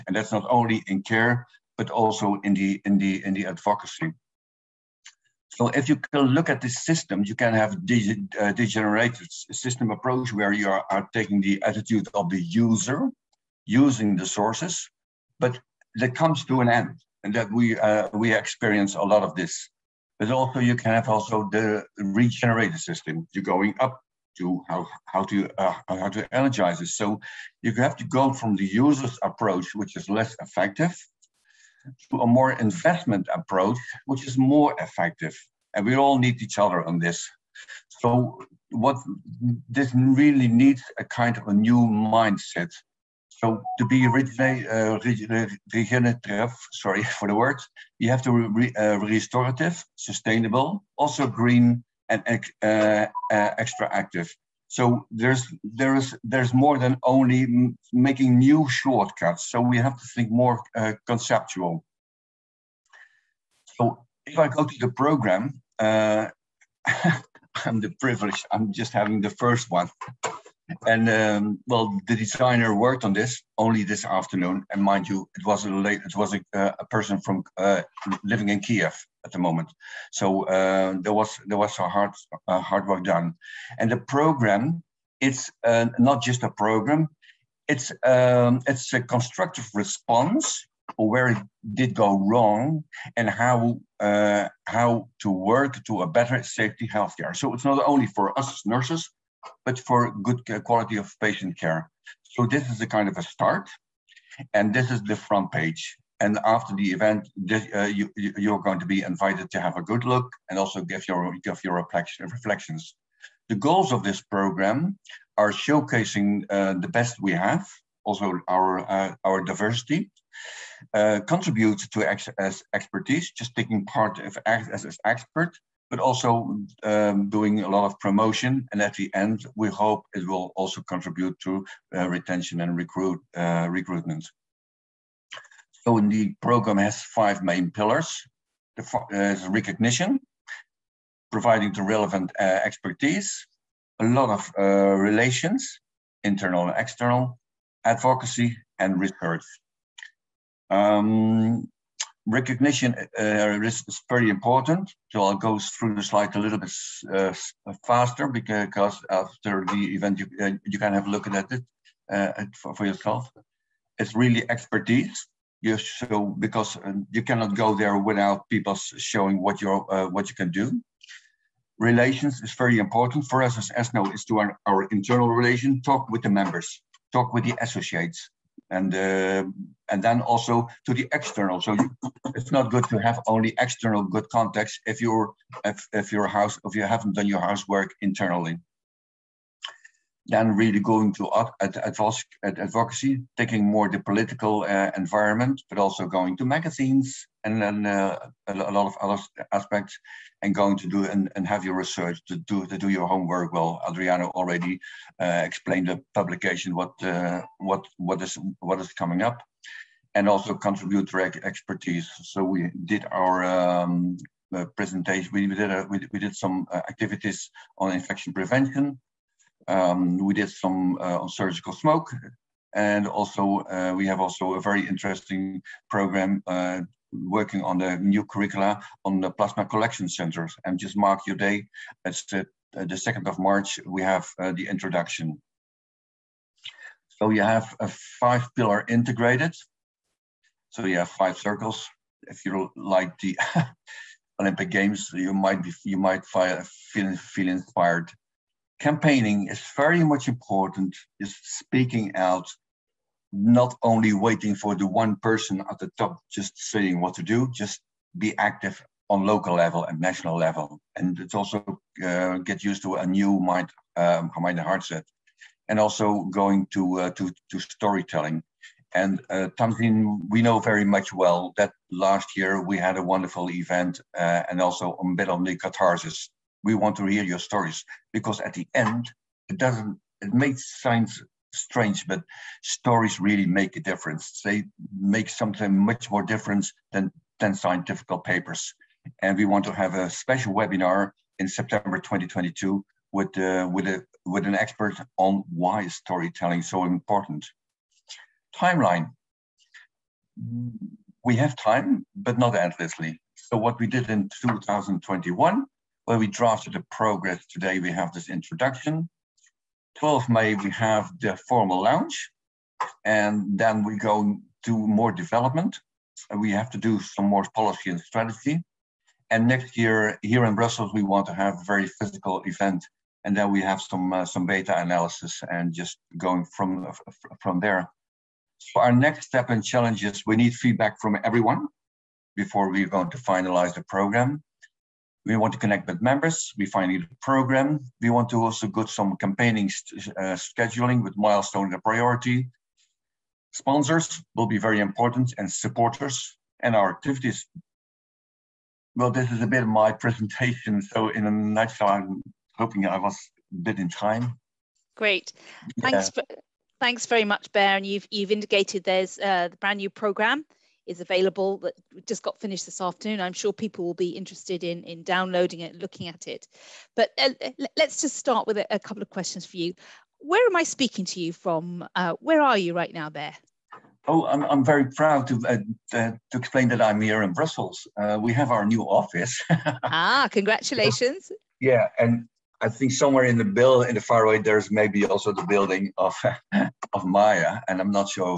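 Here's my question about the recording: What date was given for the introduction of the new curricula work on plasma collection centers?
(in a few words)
2nd of March.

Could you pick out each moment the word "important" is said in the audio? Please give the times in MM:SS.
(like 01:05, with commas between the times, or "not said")
02:34, 02:52, 04:10, 04:56, 05:44.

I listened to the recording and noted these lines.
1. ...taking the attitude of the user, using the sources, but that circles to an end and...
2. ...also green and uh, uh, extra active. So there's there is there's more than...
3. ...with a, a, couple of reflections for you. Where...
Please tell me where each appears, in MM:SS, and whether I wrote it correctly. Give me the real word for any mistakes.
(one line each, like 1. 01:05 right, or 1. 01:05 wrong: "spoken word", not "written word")
1. 00:11 wrong: "comes", not "circles"
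2. 00:50 right
3. 06:08 wrong: "questions", not "reflections".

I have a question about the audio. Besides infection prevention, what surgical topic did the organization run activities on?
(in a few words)
Surgical smoke.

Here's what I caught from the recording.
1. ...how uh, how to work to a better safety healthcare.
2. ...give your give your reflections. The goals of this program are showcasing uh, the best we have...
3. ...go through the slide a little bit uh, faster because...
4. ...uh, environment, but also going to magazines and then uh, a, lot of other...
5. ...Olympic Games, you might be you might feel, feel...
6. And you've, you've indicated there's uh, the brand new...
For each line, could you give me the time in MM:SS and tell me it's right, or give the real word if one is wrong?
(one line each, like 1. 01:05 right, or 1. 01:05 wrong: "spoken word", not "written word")
1. 01:33 right
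2. 01:50 right
3. 02:35 right
4. 03:14 right
5. 04:04 right
6. 05:57 right.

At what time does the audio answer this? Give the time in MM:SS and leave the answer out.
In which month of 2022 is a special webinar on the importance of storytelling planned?
04:51.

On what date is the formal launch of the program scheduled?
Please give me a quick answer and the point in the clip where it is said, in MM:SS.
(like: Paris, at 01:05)
12 May, at 05:09.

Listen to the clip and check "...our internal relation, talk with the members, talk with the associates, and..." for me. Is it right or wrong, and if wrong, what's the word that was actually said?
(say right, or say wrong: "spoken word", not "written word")
right.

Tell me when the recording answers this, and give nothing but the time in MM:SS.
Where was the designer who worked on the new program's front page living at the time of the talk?
01:18.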